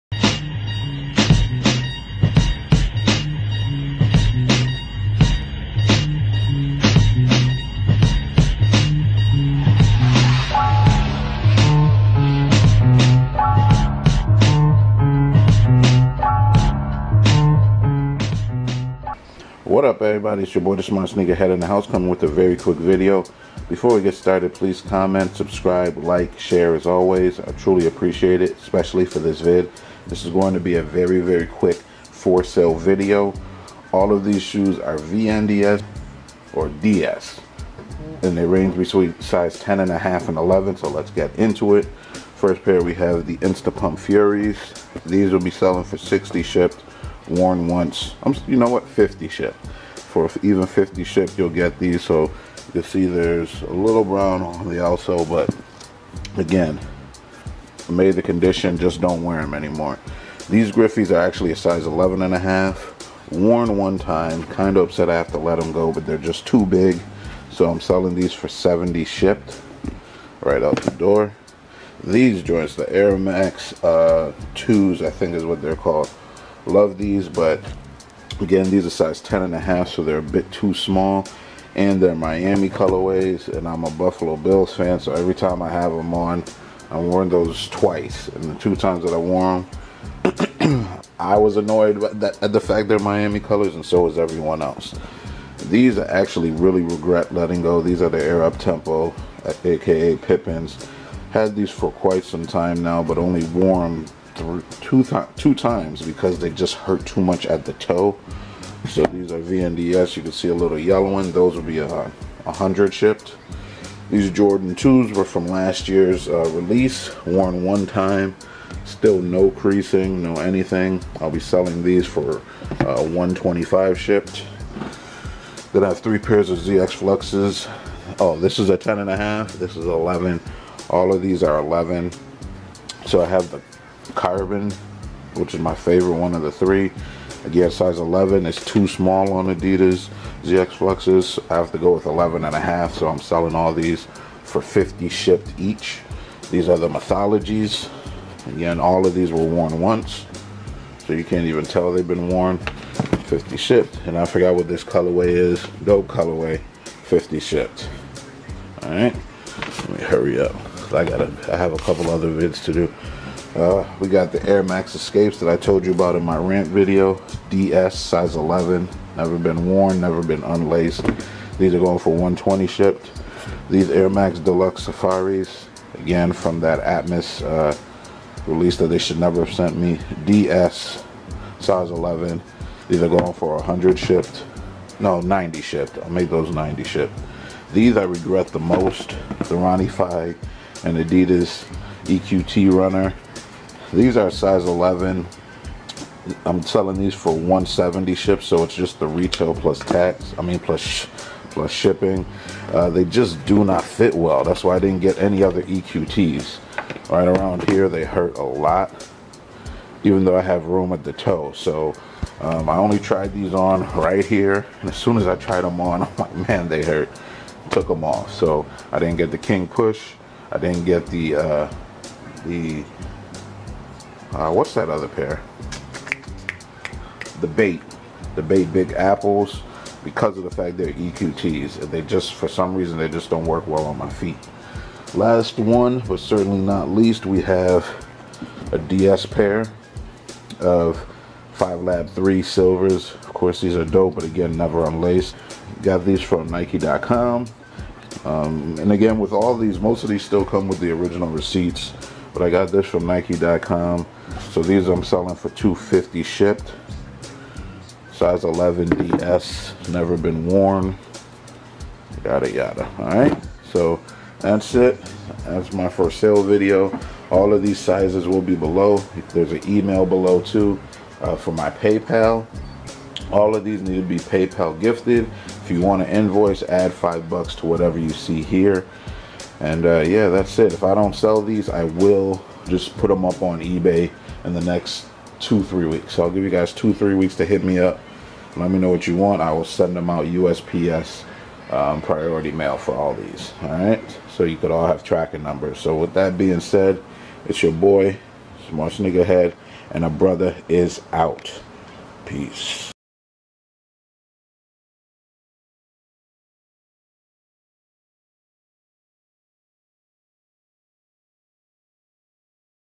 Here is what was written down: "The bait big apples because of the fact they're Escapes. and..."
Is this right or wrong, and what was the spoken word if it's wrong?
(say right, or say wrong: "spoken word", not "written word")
wrong: "EQTs", not "Escapes".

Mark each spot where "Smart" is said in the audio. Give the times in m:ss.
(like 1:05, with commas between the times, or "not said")
0:20, 4:58.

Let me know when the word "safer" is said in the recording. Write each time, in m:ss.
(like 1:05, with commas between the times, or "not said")
not said.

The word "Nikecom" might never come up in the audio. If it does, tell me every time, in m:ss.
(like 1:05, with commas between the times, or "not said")
4:06, 4:13.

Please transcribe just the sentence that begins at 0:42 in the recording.
First pair we have the Insta Pump Furies.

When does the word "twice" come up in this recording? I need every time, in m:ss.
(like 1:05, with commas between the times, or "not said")
1:27.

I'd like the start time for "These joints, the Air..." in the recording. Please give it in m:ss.
1:12.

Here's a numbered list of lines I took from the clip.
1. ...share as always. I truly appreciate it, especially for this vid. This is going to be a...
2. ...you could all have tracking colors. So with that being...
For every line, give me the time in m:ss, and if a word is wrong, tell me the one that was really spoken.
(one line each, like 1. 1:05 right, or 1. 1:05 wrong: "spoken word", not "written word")
1. 0:26 right
2. 4:54 wrong: "numbers", not "colors".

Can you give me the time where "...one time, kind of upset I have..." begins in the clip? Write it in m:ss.
1:03.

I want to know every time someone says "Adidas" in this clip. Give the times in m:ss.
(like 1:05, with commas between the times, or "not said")
2:19, 3:10.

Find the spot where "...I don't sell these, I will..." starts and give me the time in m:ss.
4:40.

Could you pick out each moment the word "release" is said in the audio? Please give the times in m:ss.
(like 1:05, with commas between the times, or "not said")
1:56, 2:58.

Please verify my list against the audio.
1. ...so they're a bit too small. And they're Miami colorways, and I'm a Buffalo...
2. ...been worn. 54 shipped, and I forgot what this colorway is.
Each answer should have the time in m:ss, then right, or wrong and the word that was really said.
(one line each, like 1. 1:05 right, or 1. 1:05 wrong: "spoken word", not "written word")
1. 1:19 right
2. 2:32 wrong: "50", not "54".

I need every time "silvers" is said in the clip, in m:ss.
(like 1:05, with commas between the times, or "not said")
4:02.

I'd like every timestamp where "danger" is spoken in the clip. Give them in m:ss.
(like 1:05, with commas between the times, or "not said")
not said.